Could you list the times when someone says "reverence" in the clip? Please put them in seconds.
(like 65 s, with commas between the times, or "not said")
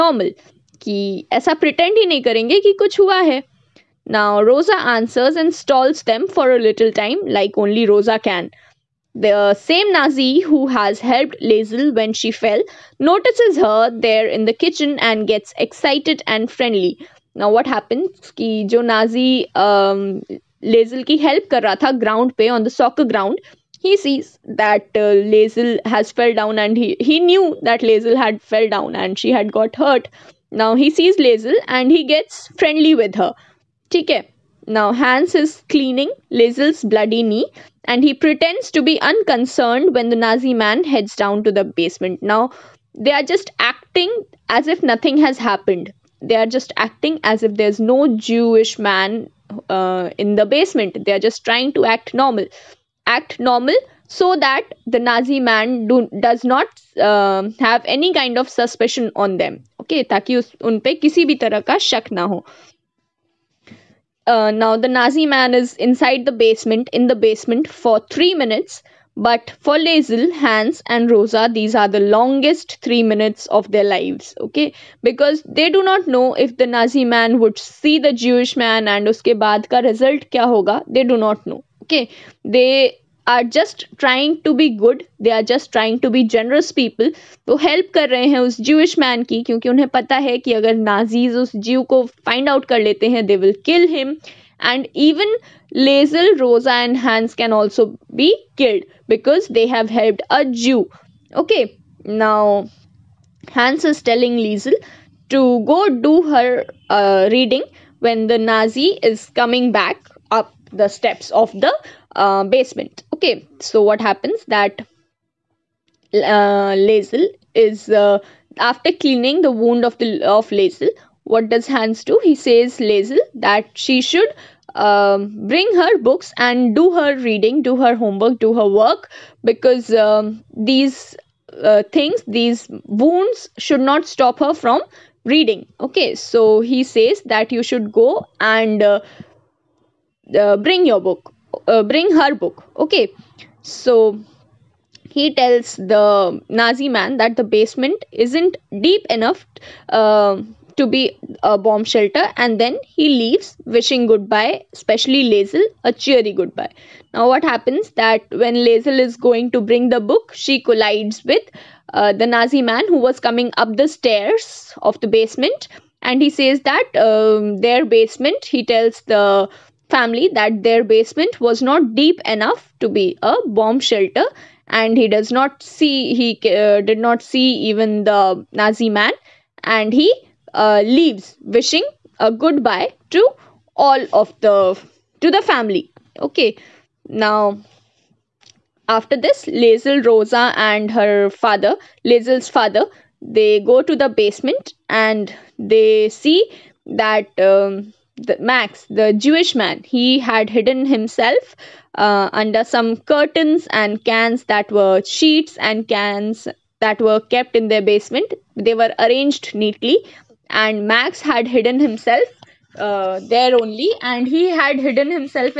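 not said.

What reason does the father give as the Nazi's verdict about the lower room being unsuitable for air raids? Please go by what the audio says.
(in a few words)
Not deep enough.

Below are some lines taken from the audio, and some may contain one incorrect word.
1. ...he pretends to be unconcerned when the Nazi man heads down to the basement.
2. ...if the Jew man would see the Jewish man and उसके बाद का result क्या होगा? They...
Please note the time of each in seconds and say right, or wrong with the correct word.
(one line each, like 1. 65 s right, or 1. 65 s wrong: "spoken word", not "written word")
1. 38 s right
2. 76 s wrong: "Nazi", not "Jew".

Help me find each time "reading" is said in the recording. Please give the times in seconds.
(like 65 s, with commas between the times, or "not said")
107 s, 127 s, 135 s.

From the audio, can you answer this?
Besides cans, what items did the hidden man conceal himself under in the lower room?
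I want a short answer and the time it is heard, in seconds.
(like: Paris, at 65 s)
Curtains, at 202 s.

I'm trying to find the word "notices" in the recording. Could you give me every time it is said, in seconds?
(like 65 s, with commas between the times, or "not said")
13 s.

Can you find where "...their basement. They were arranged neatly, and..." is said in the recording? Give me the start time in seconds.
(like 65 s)
207 s.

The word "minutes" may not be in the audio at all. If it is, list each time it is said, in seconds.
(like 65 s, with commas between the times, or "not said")
68 s, 73 s.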